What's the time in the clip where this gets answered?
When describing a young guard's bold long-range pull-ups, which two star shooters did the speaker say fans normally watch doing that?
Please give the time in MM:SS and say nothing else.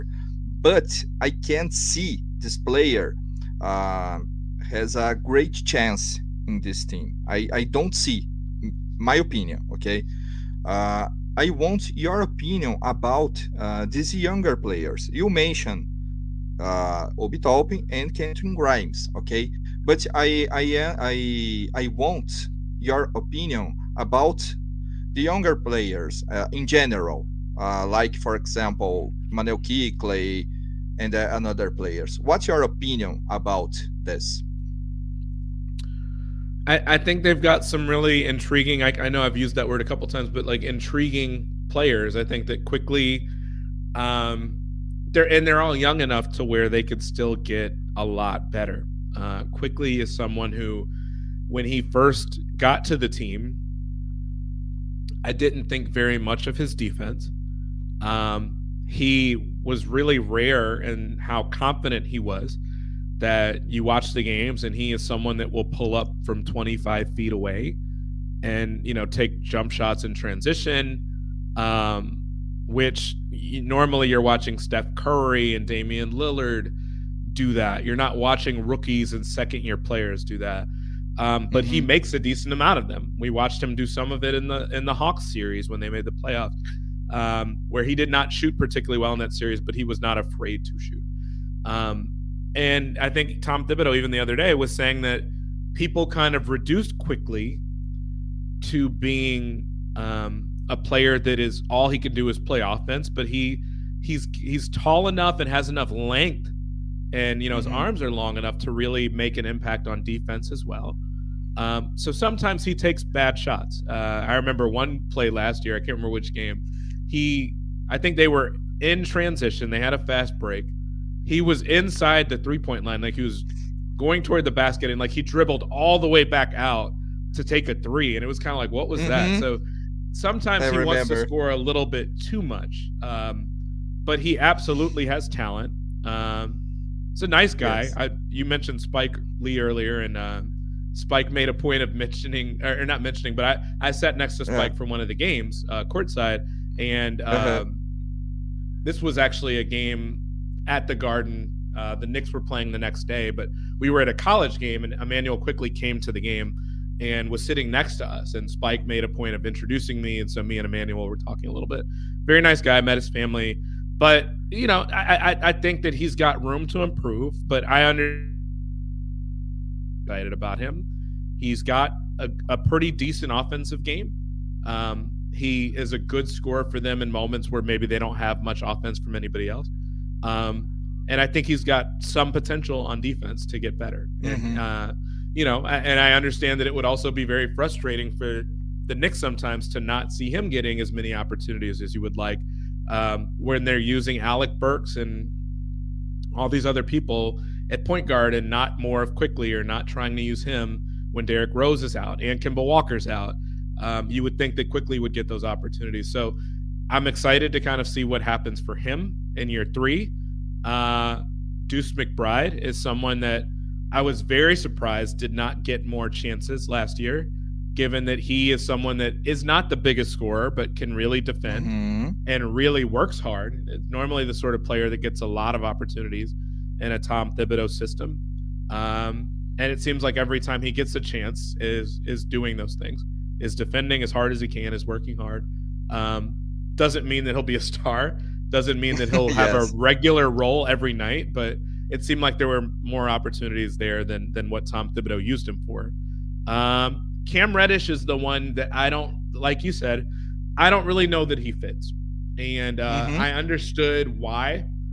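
01:14.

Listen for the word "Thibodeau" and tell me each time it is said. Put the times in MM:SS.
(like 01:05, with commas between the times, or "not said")
01:33, 03:47, 04:04.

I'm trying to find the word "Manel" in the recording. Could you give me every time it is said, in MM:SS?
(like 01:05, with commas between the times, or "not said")
00:29.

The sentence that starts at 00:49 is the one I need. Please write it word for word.
Uh, Quickley is someone who, when he first got to the team, I didn't think very much of his defense.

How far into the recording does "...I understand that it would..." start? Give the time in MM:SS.
03:05.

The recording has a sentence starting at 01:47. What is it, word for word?
his arms are long enough to really make an impact on defense as well um, so sometimes he takes bad shots.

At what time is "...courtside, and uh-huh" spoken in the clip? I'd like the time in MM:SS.
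02:25.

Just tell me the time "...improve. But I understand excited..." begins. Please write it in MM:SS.
02:46.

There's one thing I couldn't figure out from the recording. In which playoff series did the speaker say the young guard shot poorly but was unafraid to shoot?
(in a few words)
Hawks series.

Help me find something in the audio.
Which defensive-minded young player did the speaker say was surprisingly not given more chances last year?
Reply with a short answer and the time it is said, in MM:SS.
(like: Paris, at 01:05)
Deuce McBride, at 03:31.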